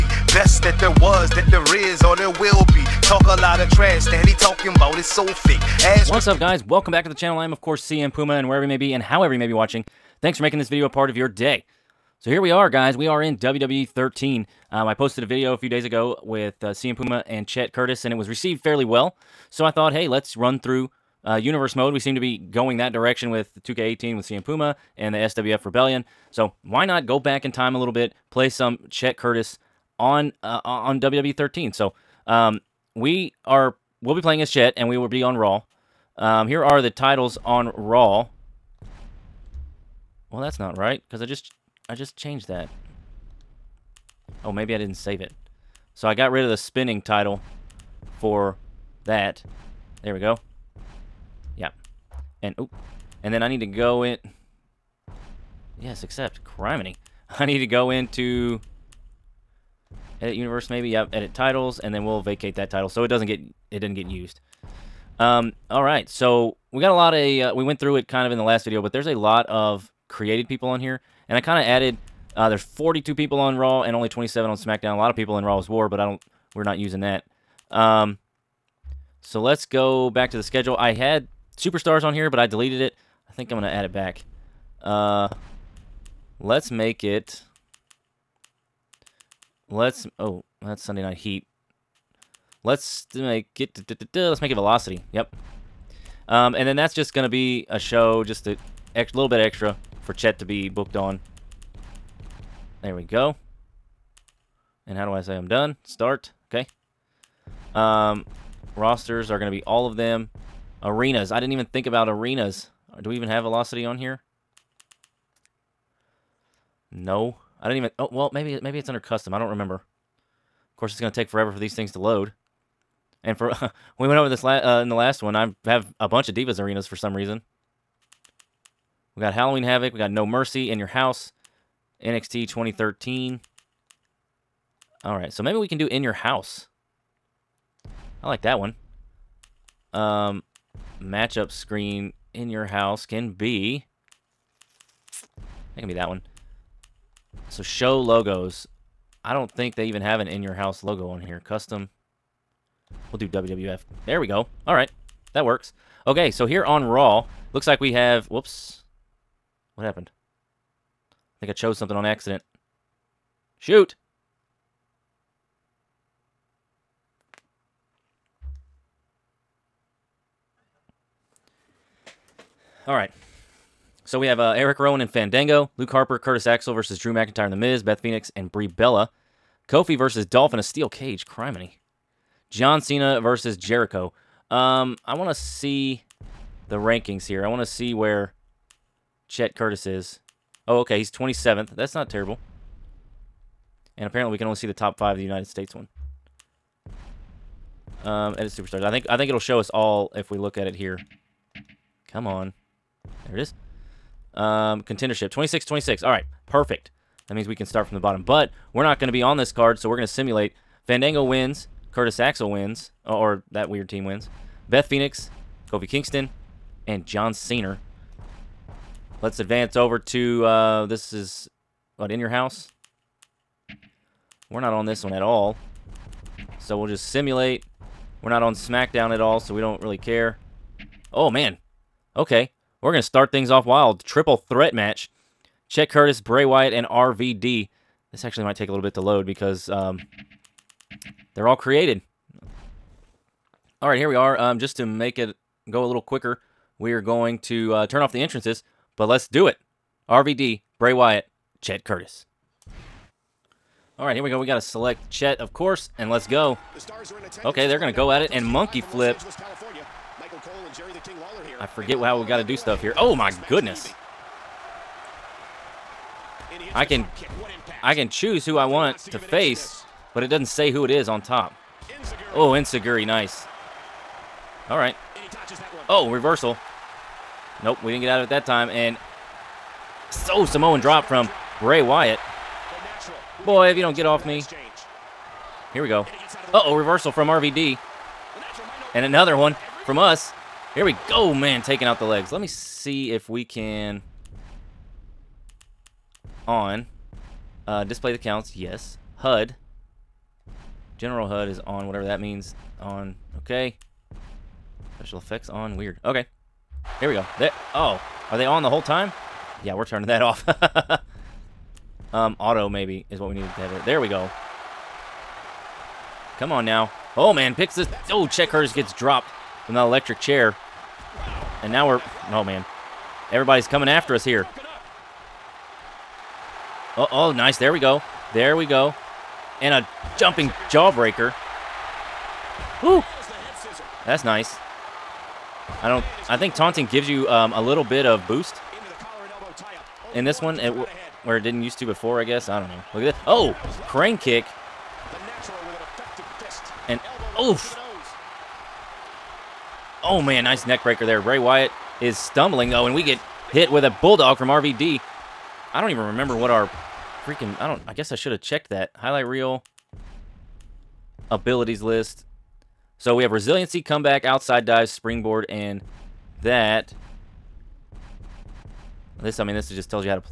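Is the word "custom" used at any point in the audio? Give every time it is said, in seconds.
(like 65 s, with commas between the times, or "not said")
118 s, 151 s.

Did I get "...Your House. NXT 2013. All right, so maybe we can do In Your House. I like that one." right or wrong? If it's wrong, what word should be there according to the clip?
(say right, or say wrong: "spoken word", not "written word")
right.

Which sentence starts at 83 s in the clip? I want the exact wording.
I think I'm going to add it back.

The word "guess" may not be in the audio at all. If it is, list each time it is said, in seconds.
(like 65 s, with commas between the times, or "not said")
342 s, 357 s.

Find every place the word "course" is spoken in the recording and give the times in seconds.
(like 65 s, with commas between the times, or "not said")
7 s, 120 s, 255 s.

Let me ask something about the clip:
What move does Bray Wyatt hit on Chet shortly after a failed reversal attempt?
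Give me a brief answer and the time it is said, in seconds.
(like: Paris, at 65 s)
Samoan drop, at 280 s.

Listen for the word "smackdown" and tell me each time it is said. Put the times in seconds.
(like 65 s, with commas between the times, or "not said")
74 s, 228 s.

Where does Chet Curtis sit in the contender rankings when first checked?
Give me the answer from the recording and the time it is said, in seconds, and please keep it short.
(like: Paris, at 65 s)
27th, at 191 s.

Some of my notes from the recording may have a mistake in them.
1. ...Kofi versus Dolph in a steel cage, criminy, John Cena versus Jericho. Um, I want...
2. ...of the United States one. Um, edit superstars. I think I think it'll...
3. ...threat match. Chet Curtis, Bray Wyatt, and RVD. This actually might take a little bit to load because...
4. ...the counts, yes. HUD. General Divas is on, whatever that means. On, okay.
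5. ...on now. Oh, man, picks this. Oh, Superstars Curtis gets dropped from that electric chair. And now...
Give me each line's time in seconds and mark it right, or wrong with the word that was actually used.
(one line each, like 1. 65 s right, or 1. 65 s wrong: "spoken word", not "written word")
1. 179 s right
2. 195 s right
3. 234 s right
4. 298 s wrong: "HUD", not "Divas"
5. 316 s wrong: "Chet", not "Superstars".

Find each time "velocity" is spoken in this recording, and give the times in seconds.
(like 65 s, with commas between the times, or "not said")
94 s, 113 s.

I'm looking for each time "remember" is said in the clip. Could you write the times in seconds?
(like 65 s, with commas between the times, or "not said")
119 s, 356 s.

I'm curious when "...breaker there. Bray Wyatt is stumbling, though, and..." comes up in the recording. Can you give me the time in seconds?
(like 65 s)
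350 s.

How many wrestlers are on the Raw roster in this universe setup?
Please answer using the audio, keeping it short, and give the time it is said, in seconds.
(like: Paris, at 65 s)
42, at 72 s.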